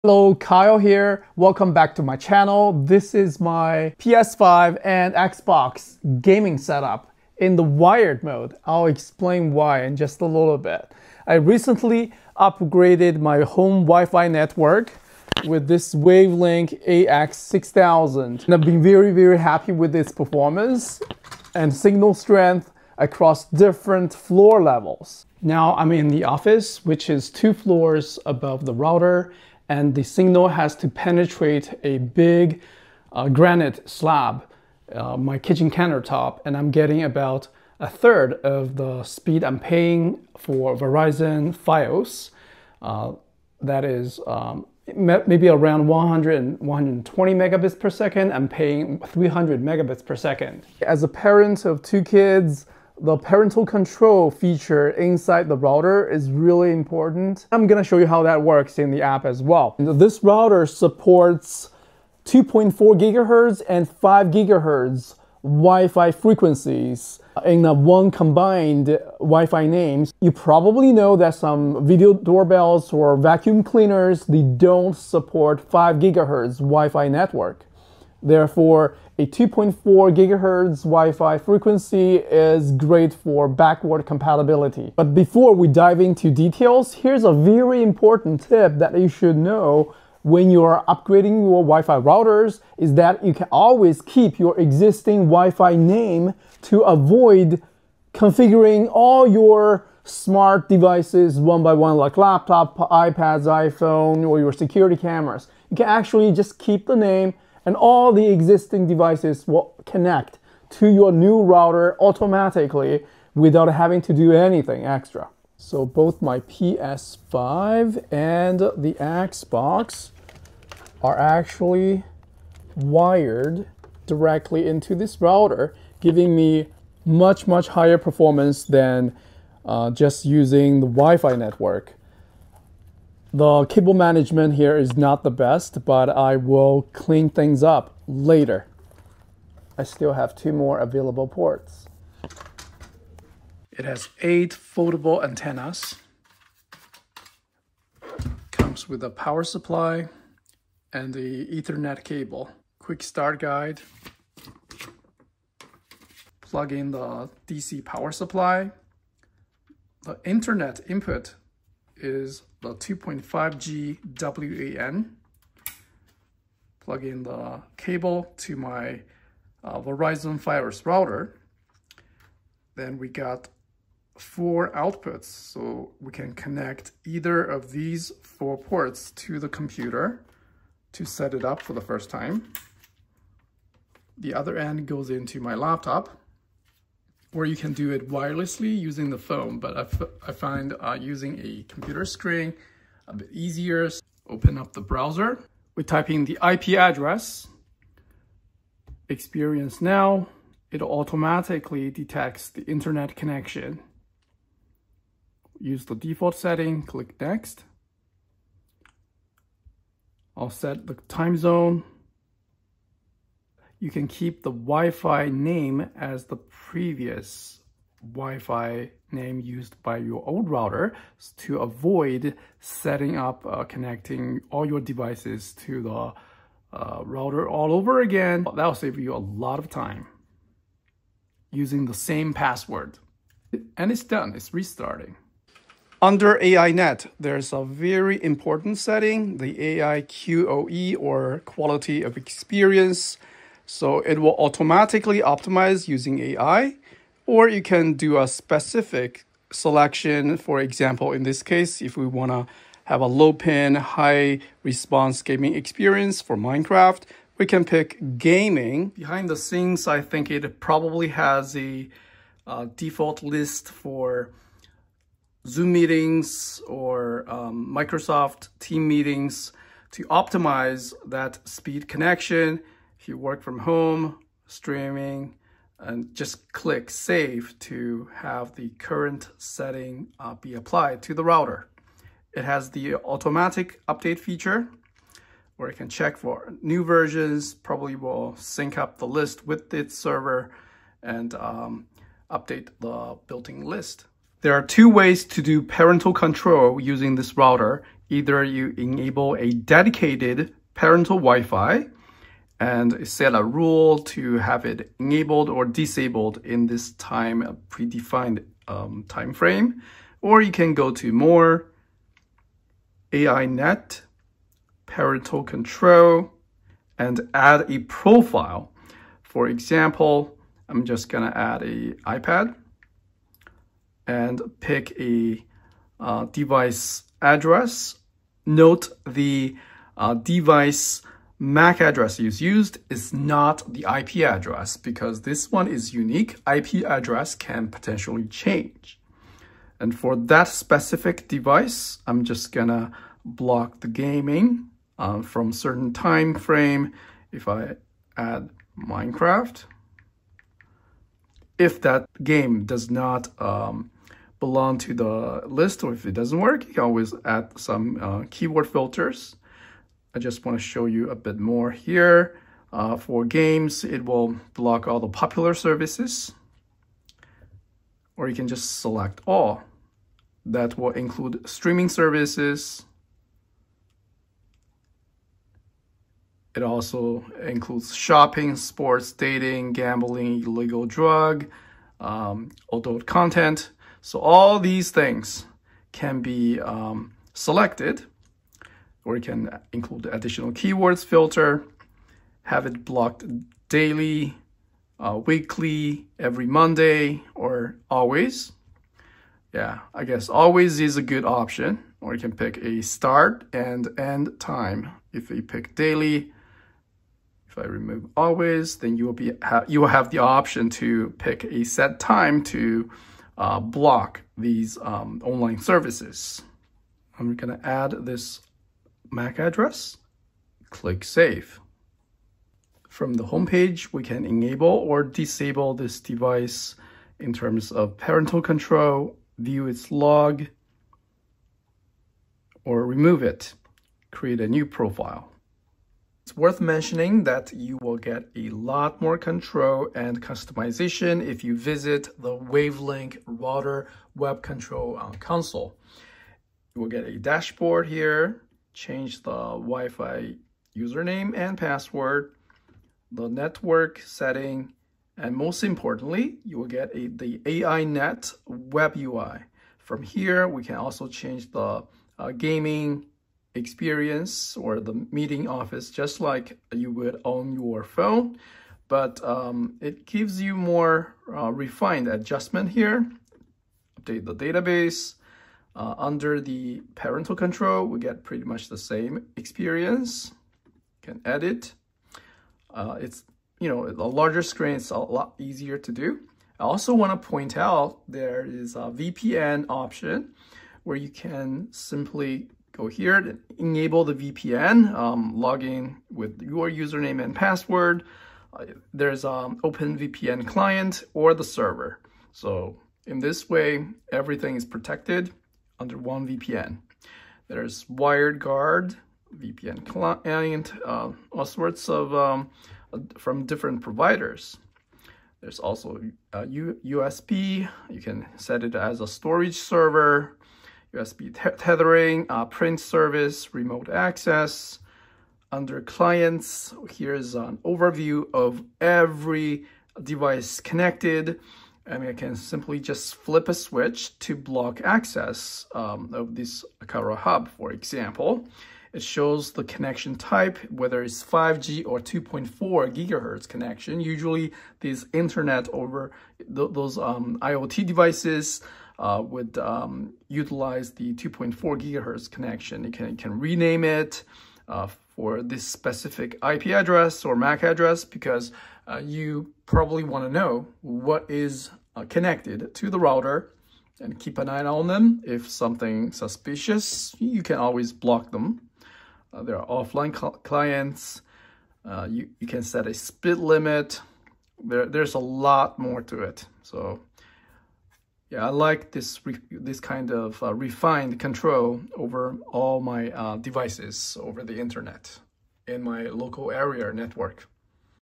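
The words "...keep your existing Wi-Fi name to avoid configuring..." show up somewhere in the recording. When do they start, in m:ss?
1:34.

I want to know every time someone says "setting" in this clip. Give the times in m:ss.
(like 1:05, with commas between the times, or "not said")
3:26, 3:42, 3:58, 4:39, 7:33.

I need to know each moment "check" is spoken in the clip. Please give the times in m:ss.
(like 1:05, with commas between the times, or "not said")
4:45.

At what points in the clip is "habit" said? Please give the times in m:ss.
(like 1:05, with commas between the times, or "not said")
not said.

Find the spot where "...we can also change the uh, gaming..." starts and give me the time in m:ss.
7:40.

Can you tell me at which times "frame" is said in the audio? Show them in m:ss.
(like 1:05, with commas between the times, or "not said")
5:09, 5:46.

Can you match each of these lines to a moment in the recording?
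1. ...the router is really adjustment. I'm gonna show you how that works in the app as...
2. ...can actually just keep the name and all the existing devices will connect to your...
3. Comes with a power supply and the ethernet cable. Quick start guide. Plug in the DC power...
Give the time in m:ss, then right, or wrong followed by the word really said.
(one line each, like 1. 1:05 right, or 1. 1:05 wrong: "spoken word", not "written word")
1. 0:55 wrong: "important", not "adjustment"
2. 1:45 right
3. 2:28 right.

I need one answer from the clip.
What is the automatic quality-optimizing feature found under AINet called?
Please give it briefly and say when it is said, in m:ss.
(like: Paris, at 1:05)
AI QoE, at 3:59.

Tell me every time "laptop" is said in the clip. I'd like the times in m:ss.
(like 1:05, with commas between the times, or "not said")
1:42, 3:05.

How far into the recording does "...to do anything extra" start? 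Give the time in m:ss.
1:54.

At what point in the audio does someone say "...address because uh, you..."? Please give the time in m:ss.
9:17.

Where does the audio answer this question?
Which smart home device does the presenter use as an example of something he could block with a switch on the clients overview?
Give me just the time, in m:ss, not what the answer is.
8:56.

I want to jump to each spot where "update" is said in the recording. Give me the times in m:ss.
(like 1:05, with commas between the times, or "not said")
4:43, 4:52, 7:54.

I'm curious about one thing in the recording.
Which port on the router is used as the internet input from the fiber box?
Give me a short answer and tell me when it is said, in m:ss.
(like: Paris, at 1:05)
2.5G WAN, at 2:42.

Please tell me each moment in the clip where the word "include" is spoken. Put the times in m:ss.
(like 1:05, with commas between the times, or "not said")
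6:10, 6:17, 6:29.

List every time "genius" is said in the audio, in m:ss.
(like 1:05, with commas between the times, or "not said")
not said.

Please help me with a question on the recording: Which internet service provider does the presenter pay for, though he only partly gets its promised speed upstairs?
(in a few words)
Verizon Fios.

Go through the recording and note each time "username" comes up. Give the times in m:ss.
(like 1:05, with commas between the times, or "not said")
7:30, 8:16.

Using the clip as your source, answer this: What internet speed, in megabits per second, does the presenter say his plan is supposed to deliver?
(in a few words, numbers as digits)
300.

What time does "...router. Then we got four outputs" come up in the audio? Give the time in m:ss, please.
2:50.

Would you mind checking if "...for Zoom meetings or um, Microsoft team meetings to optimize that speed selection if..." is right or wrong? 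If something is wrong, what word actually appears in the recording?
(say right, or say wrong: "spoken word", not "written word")
wrong: "connection", not "selection".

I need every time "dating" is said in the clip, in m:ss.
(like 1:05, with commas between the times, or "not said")
6:19.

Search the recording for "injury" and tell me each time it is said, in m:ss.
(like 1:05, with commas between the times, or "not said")
not said.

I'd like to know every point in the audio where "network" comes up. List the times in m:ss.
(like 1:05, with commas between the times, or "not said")
0:14, 1:17, 2:11, 7:33, 9:46.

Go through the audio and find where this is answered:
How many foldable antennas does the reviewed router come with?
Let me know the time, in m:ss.
2:24.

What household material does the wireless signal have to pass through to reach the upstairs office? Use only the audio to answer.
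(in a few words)
granite slab.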